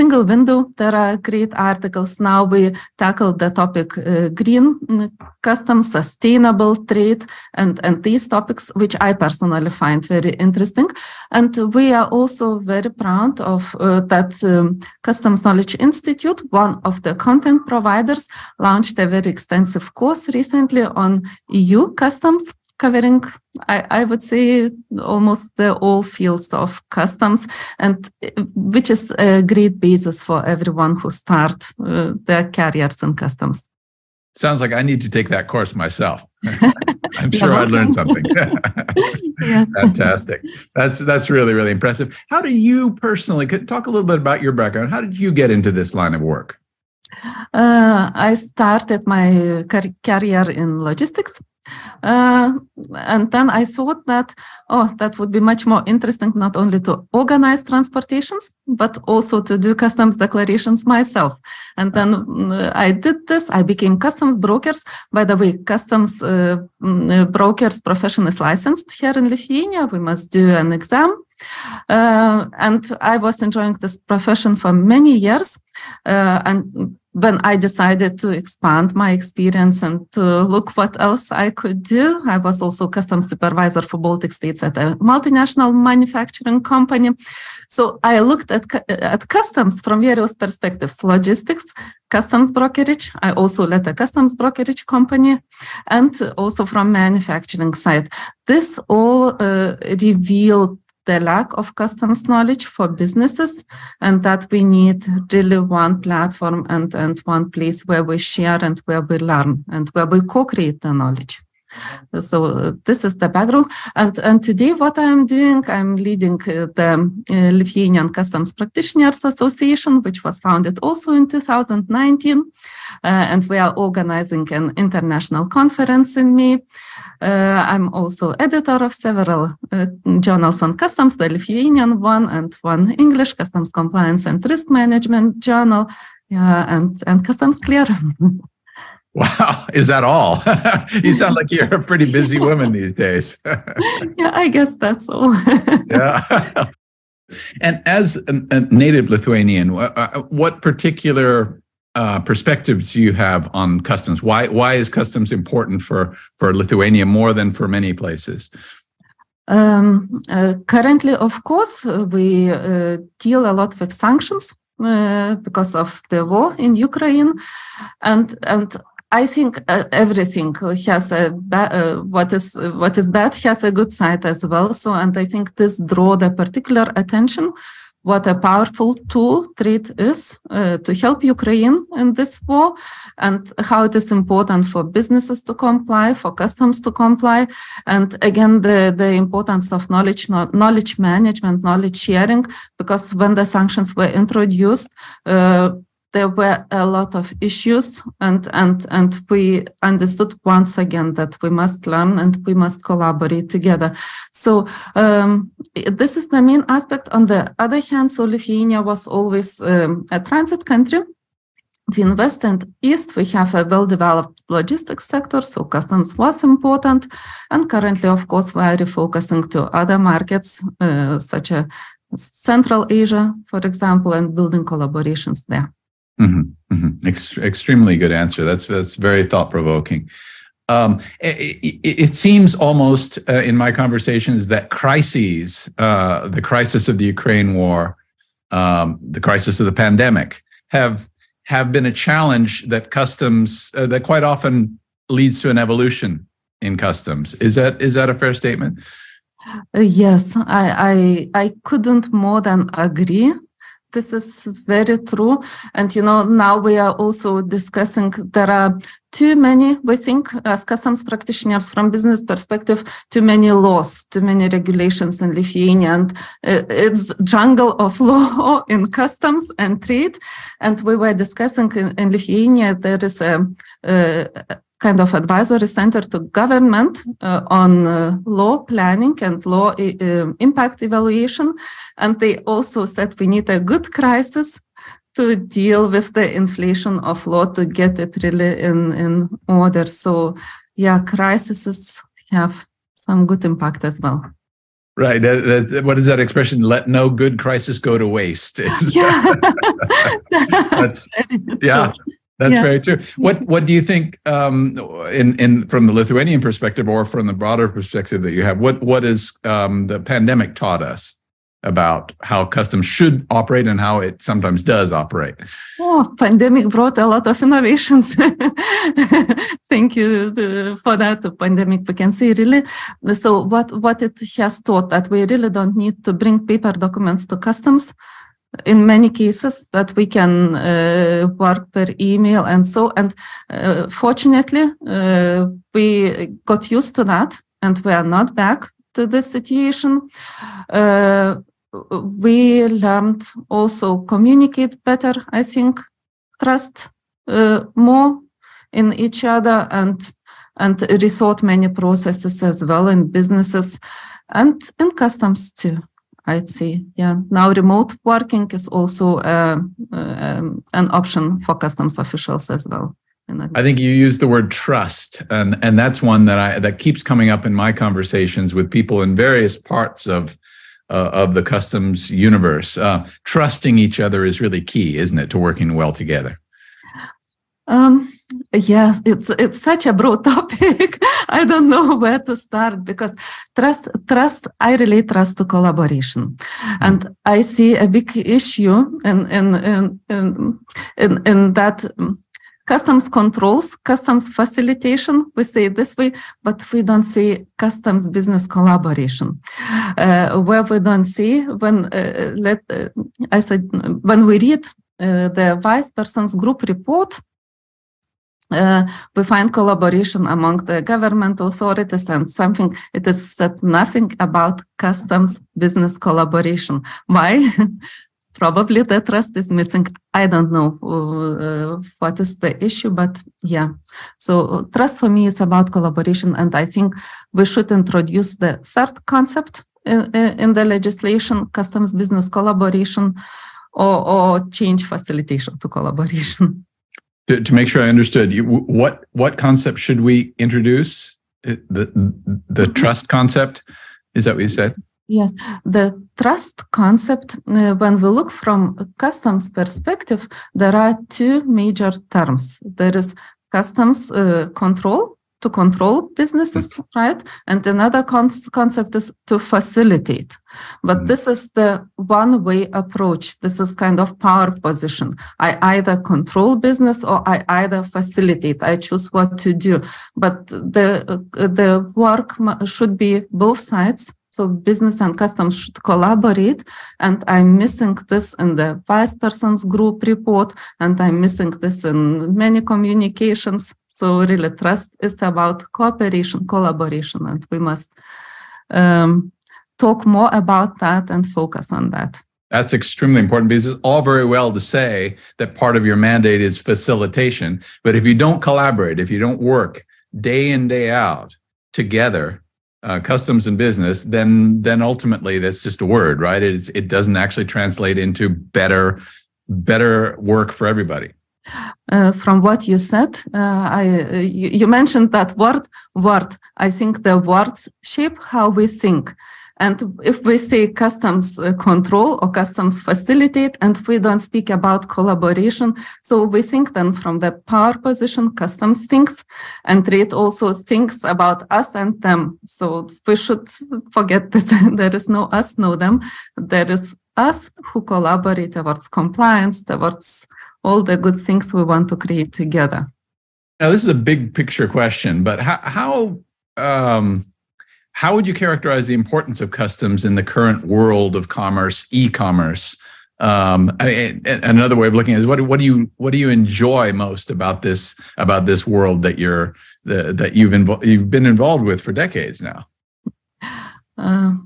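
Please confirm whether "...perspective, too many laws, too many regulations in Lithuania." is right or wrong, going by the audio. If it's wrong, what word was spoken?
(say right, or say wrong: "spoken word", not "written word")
right.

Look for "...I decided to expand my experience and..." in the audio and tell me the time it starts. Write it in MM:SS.
01:17.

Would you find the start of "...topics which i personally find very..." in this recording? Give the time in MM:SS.
00:08.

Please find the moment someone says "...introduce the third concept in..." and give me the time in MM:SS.
07:07.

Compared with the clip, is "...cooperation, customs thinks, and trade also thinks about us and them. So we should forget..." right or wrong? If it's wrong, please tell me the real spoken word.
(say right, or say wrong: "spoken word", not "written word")
wrong: "position", not "cooperation".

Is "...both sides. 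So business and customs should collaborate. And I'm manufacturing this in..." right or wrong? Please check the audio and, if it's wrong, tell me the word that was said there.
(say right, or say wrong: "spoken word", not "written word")
wrong: "missing", not "manufacturing".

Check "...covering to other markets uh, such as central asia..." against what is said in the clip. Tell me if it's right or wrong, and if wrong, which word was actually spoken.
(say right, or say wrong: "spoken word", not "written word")
wrong: "refocusing", not "covering".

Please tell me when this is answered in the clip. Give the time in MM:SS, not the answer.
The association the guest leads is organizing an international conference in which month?
02:06.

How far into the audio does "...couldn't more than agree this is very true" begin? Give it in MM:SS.
04:11.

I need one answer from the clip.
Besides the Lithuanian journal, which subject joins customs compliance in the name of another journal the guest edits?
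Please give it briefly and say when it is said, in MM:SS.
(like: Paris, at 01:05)
Risk management, at 02:14.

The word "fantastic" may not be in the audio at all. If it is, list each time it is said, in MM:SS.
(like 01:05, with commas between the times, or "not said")
00:39.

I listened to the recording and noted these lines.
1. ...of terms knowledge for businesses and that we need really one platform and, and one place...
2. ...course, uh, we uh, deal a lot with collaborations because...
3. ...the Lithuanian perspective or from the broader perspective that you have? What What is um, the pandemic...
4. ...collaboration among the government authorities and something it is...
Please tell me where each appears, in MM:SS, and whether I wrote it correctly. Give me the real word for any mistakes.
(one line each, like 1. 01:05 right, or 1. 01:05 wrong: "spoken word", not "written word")
1. 01:41 wrong: "customs", not "terms"
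2. 02:41 wrong: "sanctions", not "collaborations"
3. 05:05 right
4. 06:49 right.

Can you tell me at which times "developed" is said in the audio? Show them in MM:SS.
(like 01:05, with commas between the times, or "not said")
03:33.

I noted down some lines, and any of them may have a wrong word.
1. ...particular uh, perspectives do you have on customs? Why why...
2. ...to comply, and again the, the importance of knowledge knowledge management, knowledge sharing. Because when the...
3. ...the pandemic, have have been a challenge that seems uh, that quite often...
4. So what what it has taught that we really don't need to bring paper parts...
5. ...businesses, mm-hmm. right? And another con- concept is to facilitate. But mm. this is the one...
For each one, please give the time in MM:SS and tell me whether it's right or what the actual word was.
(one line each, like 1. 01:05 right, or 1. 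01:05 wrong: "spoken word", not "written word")
1. 02:30 right
2. 03:06 right
3. 03:59 wrong: "customs", not "seems"
4. 05:23 wrong: "documents", not "parts"
5. 07:36 right.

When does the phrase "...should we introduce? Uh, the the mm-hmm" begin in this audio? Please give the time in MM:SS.
07:19.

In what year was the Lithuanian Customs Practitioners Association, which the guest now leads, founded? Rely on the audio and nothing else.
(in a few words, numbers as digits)
2019.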